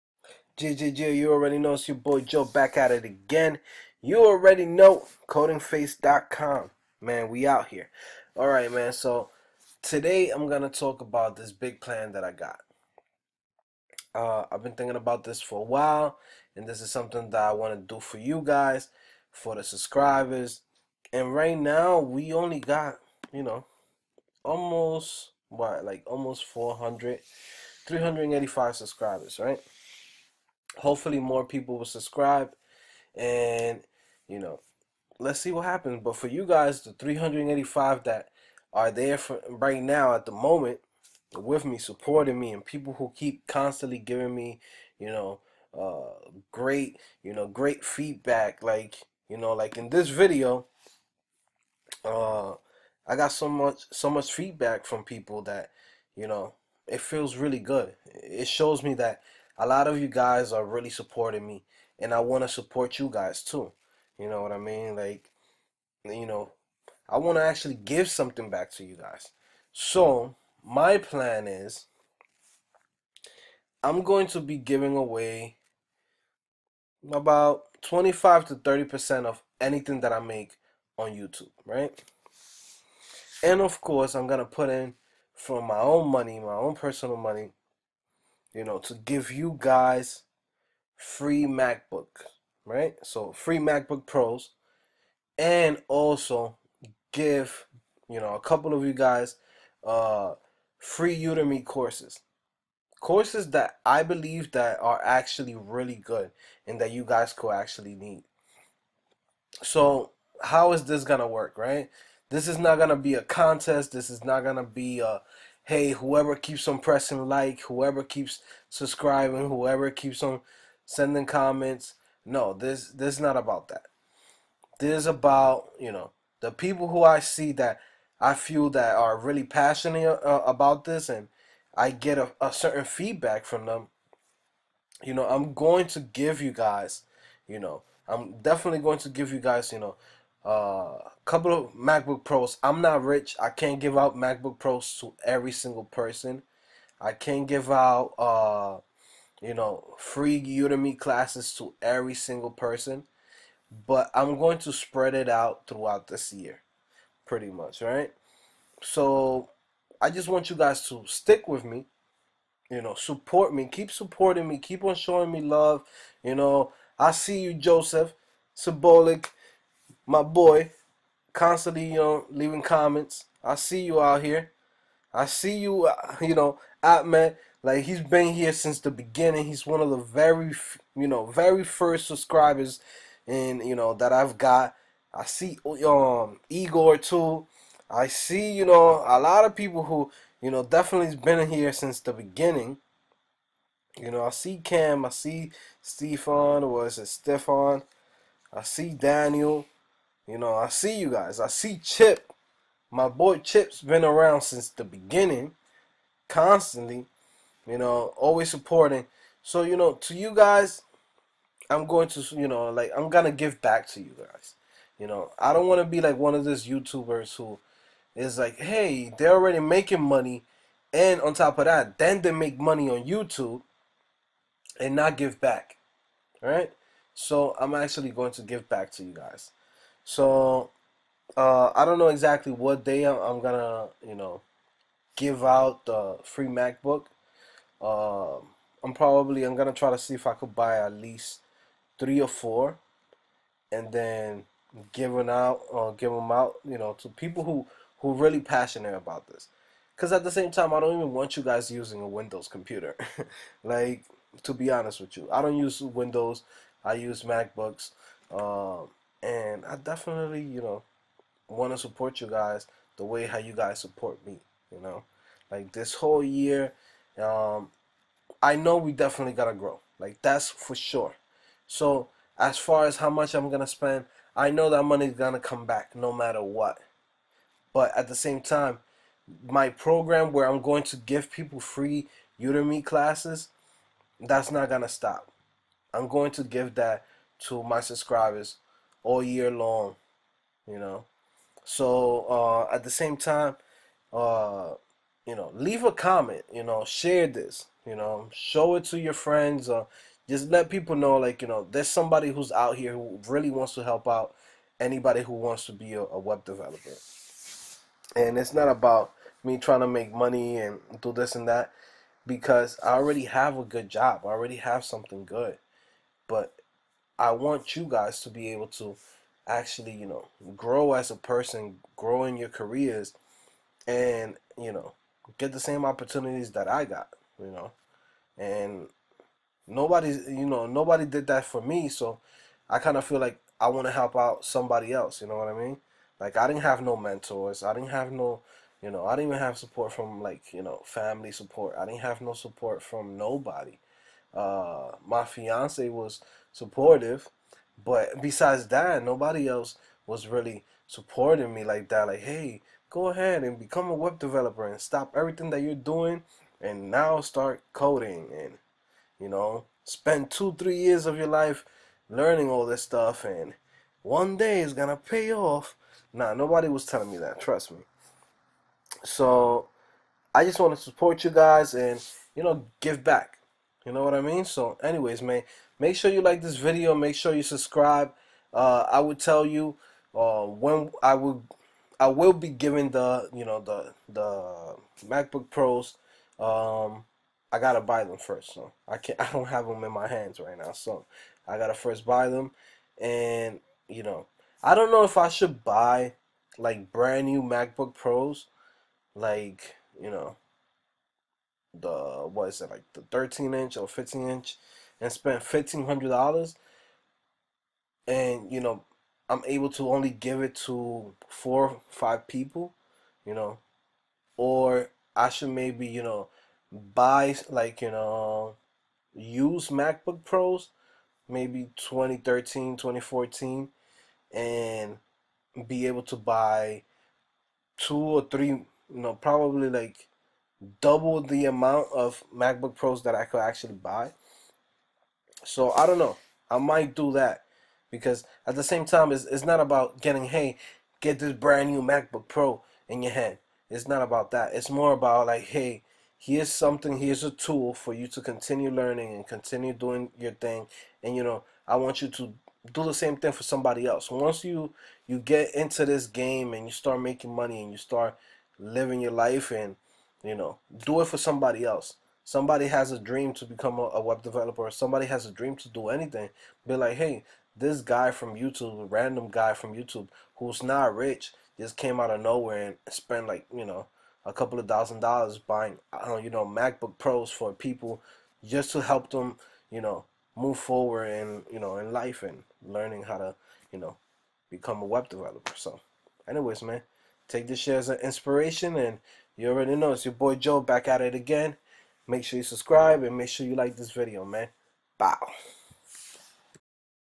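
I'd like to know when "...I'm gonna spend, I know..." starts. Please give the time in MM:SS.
04:33.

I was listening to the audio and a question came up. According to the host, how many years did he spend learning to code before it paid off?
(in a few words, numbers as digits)
Two or three.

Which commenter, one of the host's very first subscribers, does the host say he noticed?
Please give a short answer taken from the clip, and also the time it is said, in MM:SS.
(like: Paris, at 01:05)
Joseph Symbolic, at 02:47.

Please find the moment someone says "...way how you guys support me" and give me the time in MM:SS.
04:23.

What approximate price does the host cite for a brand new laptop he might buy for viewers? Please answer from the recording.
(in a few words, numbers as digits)
$1500.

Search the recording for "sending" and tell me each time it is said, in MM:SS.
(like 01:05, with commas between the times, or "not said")
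02:00.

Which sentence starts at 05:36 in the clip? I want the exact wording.
Like, I didn't have no mentors.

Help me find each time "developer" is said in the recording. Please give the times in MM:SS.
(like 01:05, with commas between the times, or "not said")
05:06, 05:54, 07:44, 08:05.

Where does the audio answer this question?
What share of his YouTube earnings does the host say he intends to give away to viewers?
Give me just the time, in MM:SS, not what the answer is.
01:17.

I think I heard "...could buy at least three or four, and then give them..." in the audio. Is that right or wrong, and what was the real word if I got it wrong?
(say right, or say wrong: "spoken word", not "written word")
right.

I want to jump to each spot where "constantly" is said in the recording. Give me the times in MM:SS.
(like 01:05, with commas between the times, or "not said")
00:43, 02:51, 03:26.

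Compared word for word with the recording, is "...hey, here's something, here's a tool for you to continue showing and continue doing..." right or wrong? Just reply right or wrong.
wrong.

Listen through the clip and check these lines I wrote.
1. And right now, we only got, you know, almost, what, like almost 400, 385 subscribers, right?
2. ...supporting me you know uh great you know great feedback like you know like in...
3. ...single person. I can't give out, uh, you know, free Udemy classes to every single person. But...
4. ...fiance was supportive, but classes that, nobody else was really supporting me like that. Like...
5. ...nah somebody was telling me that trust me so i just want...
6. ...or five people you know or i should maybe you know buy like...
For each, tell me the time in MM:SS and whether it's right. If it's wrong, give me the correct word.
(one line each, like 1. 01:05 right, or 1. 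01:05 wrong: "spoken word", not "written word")
1. 00:21 right
2. 00:43 wrong: "giving", not "supporting"
3. 02:25 right
4. 05:45 wrong: "besides", not "classes"
5. 06:06 wrong: "nobody", not "somebody"
6. 06:51 right.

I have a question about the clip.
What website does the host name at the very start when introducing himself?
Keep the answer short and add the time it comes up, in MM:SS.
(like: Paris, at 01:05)
codingphase.com, at 00:05.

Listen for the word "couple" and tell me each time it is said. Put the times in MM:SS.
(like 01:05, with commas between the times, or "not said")
01:38, 02:21, 07:54.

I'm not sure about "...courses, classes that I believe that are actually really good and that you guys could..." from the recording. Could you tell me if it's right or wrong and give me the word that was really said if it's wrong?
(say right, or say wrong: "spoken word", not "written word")
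wrong: "courses", not "classes".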